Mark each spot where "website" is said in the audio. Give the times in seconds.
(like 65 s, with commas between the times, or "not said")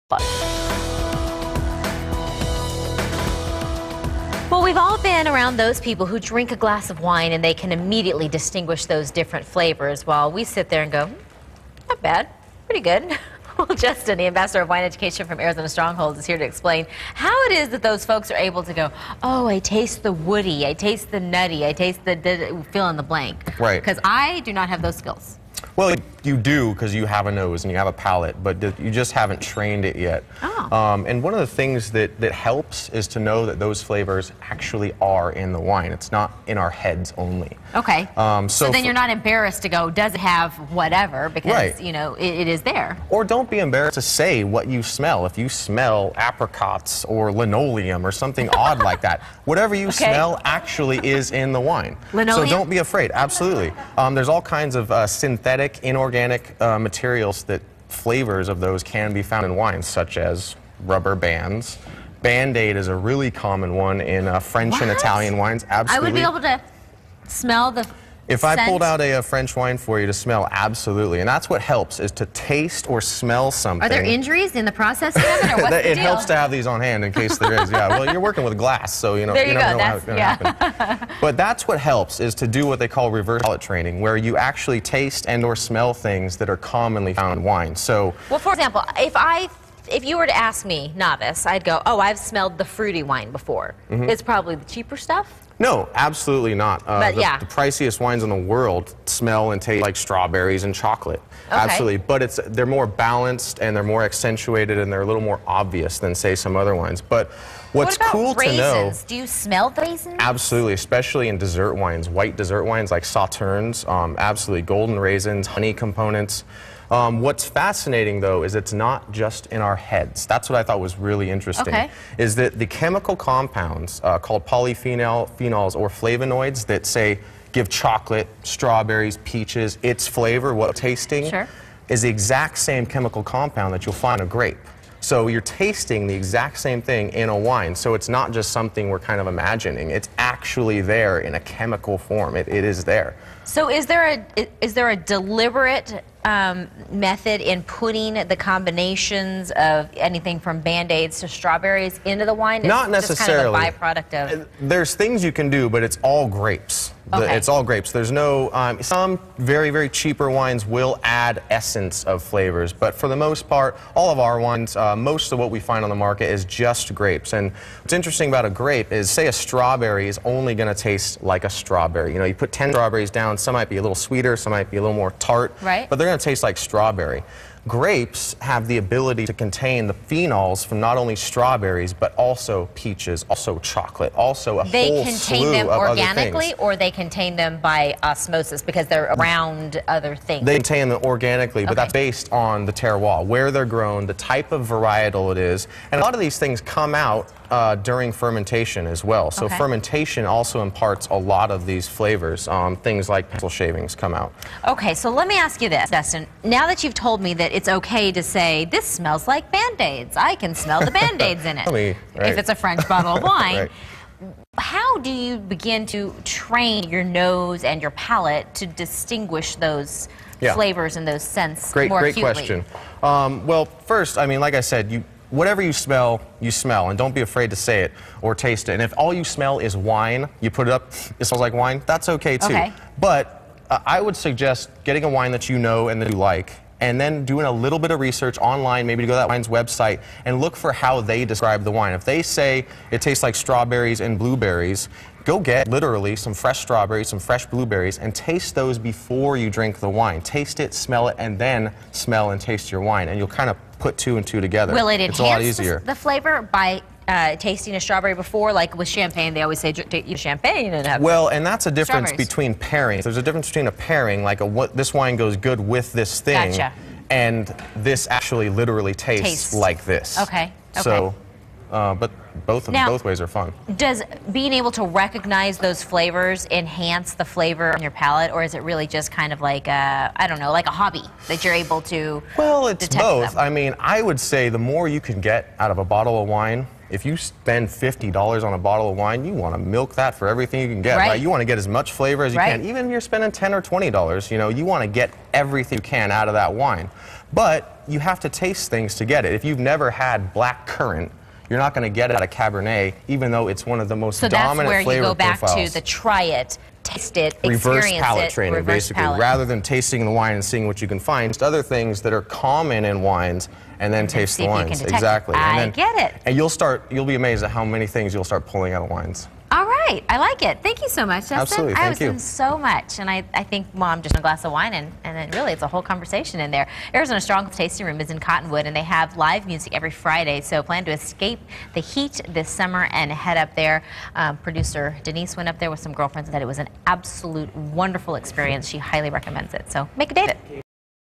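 239 s.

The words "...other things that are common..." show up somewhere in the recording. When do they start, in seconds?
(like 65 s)
311 s.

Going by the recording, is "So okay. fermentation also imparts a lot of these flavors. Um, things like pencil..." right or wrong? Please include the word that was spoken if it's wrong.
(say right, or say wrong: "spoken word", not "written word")
right.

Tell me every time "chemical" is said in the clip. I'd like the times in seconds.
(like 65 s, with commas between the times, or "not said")
122 s, 132 s, 141 s.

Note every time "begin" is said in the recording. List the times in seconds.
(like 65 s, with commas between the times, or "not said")
215 s.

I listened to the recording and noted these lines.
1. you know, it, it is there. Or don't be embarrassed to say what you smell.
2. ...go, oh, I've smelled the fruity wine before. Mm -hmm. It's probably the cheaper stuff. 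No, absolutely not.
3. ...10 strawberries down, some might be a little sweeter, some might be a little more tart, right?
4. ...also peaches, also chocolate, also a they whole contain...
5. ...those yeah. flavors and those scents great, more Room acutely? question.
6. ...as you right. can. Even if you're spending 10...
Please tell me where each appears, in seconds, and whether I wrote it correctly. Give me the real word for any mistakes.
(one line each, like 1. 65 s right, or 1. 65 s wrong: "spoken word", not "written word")
1. 41 s right
2. 91 s right
3. 172 s right
4. 182 s right
5. 219 s wrong: "Great", not "Room"
6. 292 s right.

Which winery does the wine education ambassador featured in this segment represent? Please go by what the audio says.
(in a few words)
Arizona Stronghold.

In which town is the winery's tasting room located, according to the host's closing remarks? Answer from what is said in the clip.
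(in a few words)
Cottonwood.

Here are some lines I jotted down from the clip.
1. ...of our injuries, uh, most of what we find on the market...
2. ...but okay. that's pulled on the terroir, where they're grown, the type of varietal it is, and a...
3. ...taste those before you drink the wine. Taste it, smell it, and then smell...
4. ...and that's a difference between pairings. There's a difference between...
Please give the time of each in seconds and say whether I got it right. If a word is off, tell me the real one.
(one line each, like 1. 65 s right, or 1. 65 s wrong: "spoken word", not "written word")
1. 164 s wrong: "wines", not "injuries"
2. 191 s wrong: "based", not "pulled"
3. 248 s right
4. 261 s right.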